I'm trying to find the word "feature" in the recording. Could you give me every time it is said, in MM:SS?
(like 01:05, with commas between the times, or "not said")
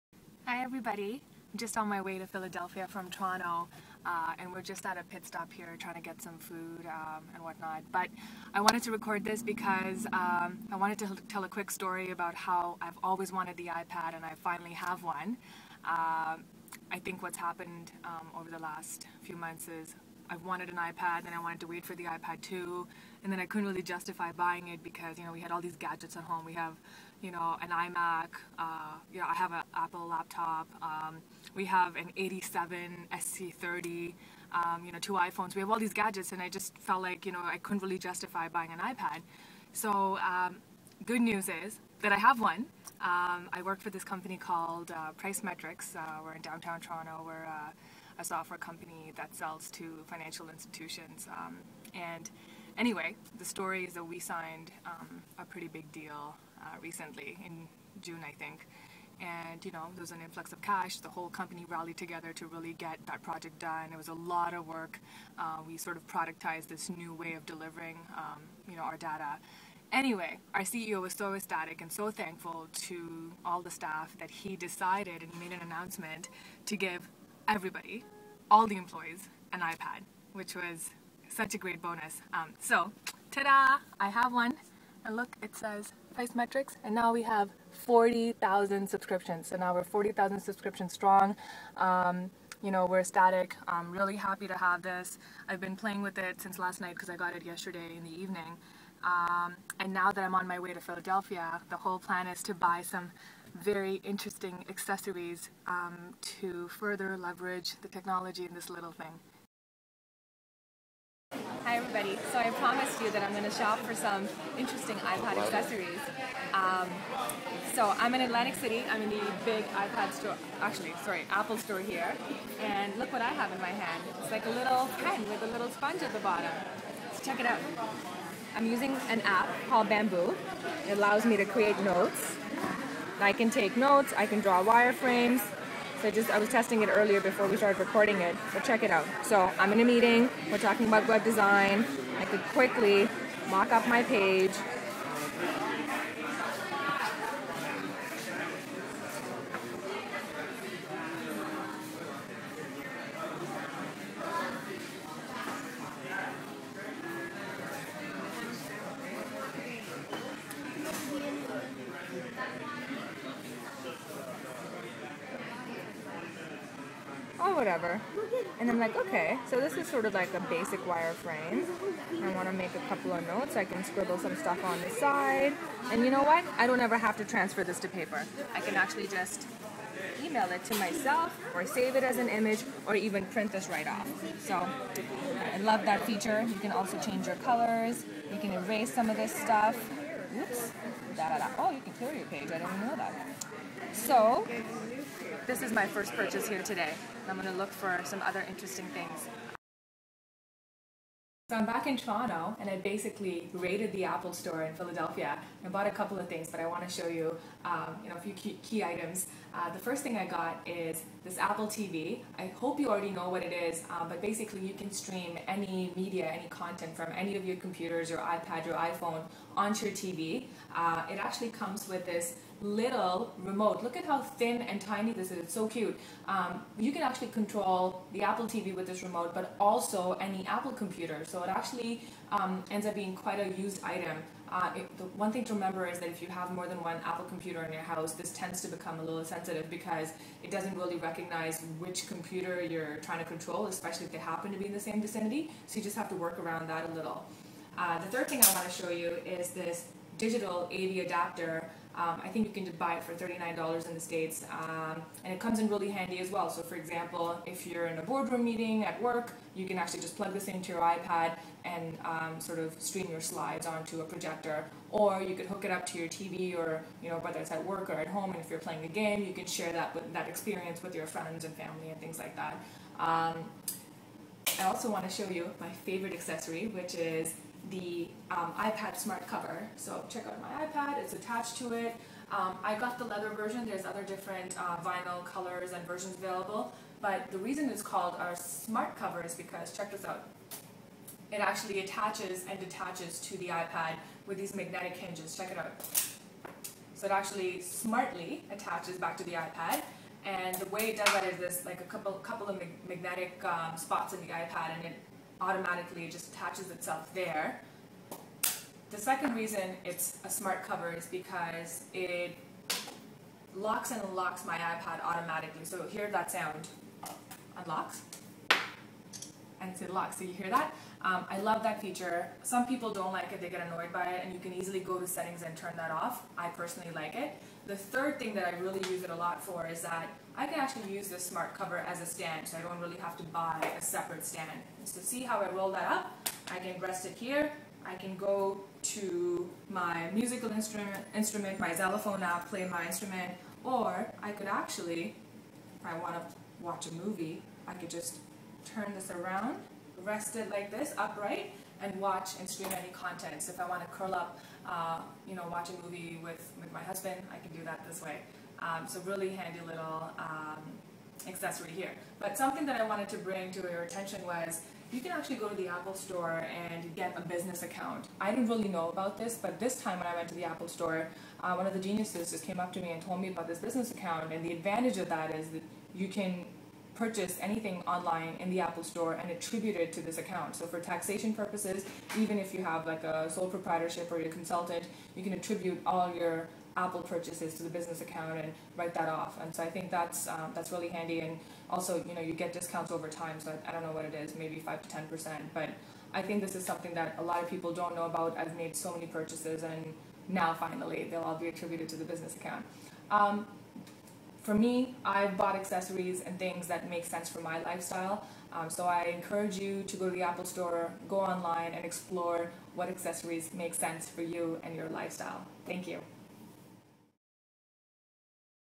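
03:06, 05:21.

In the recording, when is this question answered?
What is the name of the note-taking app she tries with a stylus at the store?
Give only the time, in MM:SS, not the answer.
02:09.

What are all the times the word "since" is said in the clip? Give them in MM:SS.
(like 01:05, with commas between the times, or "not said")
01:36.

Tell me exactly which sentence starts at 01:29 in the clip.
So now we're 40,000 subscriptions strong.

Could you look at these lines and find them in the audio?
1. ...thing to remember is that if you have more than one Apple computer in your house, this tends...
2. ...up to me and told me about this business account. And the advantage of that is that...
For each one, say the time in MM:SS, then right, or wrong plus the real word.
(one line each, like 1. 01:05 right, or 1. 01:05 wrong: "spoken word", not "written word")
1. 03:55 right
2. 06:12 right.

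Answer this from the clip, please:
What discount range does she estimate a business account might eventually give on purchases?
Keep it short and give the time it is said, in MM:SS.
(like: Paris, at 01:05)
5 to 10 percent, at 06:34.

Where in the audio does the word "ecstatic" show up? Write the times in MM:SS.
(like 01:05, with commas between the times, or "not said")
01:11, 01:32.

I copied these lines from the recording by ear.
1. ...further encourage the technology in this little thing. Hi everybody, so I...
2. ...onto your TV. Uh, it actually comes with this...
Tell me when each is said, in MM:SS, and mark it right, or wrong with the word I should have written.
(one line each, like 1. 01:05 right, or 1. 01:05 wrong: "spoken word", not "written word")
1. 01:46 wrong: "leverage", not "encourage"
2. 03:39 right.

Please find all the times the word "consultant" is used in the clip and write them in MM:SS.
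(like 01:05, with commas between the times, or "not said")
06:24.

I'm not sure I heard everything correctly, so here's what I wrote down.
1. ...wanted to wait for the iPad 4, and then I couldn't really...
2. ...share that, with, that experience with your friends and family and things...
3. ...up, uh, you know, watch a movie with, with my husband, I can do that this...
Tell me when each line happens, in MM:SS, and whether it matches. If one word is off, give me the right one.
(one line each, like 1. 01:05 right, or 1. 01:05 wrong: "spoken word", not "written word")
1. 00:21 wrong: "2", not "4"
2. 04:29 right
3. 05:54 right.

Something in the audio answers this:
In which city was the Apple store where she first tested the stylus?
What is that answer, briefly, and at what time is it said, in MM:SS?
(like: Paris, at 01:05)
Atlantic City, at 01:58.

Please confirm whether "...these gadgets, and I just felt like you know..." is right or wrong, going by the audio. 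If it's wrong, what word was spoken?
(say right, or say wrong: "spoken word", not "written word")
right.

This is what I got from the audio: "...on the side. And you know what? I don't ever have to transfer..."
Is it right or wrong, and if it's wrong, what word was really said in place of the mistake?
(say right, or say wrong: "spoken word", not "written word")
right.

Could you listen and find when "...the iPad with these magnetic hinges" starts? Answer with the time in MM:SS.
04:53.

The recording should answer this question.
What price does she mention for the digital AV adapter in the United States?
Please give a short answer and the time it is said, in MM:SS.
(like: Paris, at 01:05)
$39, at 04:13.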